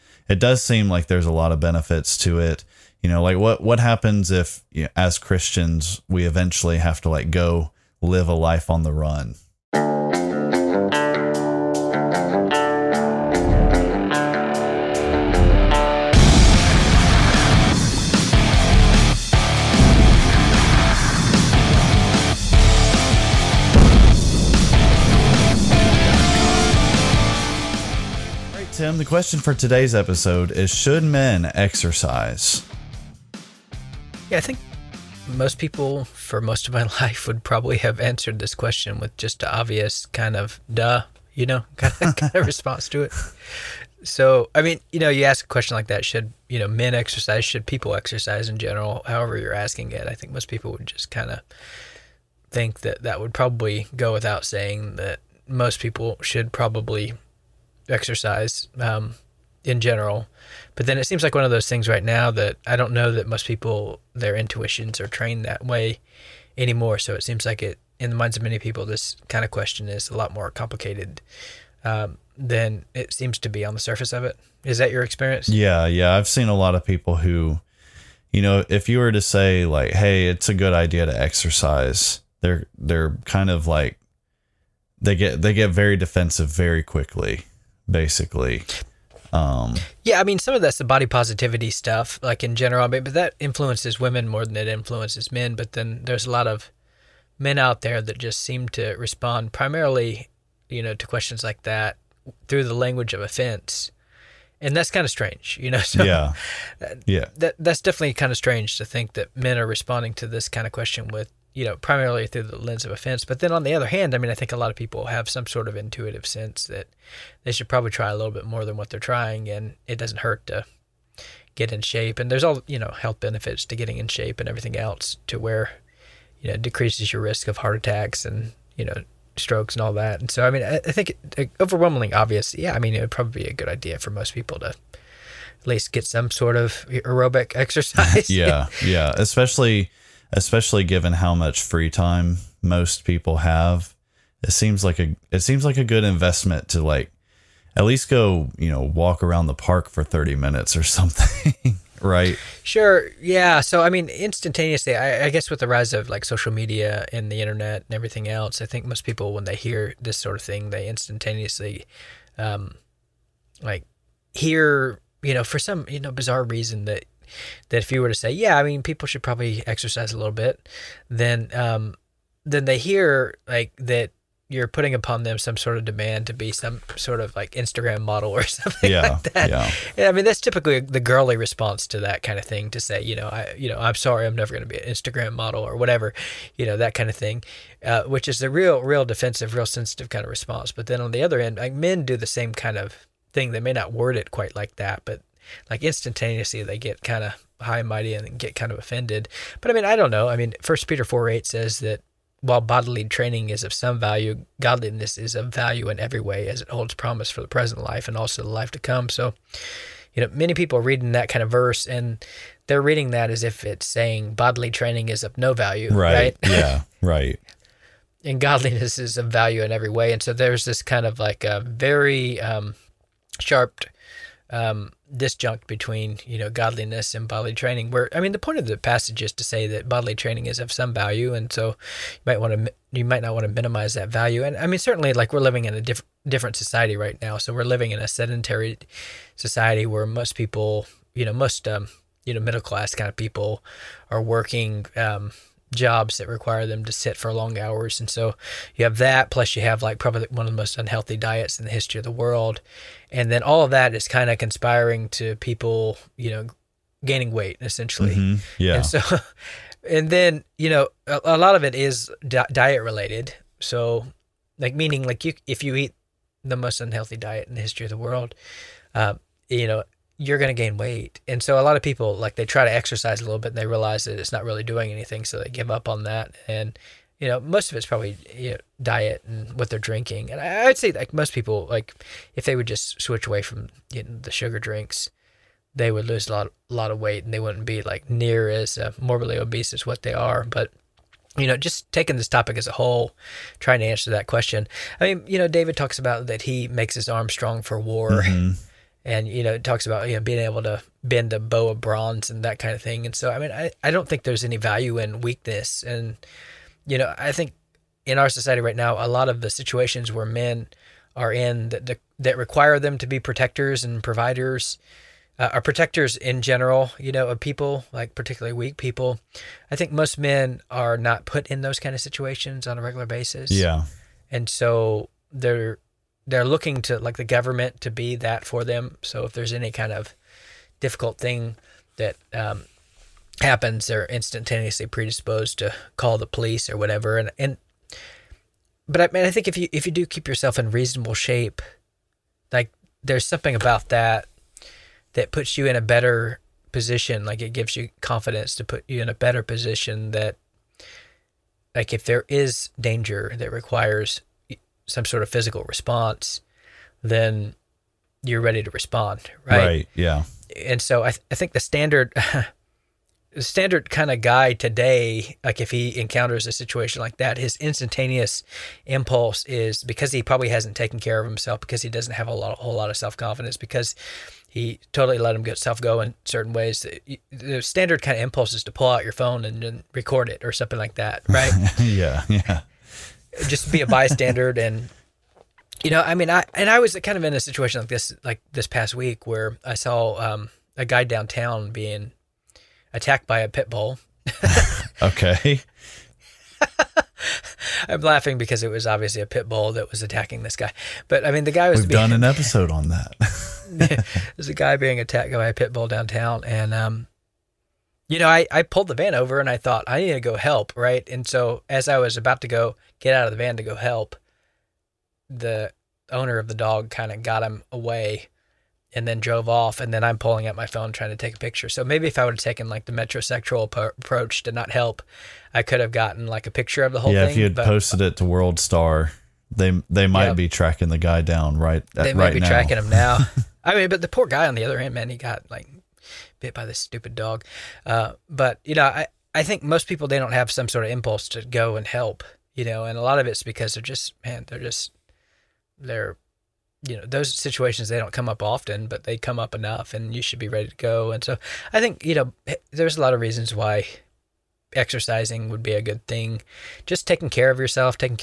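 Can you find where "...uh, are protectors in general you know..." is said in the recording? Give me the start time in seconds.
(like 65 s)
315 s.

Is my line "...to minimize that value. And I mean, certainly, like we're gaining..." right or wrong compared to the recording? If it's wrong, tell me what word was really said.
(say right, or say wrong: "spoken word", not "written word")
wrong: "living", not "gaining".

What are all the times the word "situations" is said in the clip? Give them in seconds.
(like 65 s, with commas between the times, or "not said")
309 s, 321 s, 366 s, 387 s, 447 s.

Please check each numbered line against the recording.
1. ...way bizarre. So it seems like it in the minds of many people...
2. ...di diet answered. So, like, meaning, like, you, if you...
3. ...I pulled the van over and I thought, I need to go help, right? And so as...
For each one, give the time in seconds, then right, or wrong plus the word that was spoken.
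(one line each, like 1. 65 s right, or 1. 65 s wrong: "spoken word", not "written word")
1. 65 s wrong: "anymore", not "bizarre"
2. 262 s wrong: "related", not "answered"
3. 408 s right.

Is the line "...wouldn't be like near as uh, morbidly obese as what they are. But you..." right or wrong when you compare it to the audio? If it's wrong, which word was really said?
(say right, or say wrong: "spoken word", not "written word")
right.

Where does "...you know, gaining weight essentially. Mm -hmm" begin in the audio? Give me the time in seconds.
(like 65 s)
256 s.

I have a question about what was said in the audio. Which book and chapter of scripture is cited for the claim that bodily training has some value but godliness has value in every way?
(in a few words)
First Peter 4.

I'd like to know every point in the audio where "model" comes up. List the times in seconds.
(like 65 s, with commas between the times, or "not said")
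178 s, 185 s.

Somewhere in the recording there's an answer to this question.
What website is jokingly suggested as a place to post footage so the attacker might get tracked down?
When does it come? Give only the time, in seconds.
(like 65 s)
428 s.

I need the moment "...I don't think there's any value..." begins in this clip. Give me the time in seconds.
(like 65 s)
303 s.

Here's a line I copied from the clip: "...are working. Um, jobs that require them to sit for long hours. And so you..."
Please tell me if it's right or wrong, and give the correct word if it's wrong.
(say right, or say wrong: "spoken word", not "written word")
right.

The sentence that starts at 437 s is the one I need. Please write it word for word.
Uh, but you know, I I think most people they don't have some sort of impulse to go and help.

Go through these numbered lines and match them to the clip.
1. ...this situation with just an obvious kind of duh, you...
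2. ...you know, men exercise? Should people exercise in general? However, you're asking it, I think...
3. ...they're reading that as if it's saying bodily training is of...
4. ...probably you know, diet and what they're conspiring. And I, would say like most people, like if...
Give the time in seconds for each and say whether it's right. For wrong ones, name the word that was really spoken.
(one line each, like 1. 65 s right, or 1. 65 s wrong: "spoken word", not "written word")
1. 38 s wrong: "question", not "situation"
2. 46 s right
3. 212 s right
4. 277 s wrong: "drinking", not "conspiring".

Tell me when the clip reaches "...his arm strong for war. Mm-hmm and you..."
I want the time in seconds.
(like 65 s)
296 s.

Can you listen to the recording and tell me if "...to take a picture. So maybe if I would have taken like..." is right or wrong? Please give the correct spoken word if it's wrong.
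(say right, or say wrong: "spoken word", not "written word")
right.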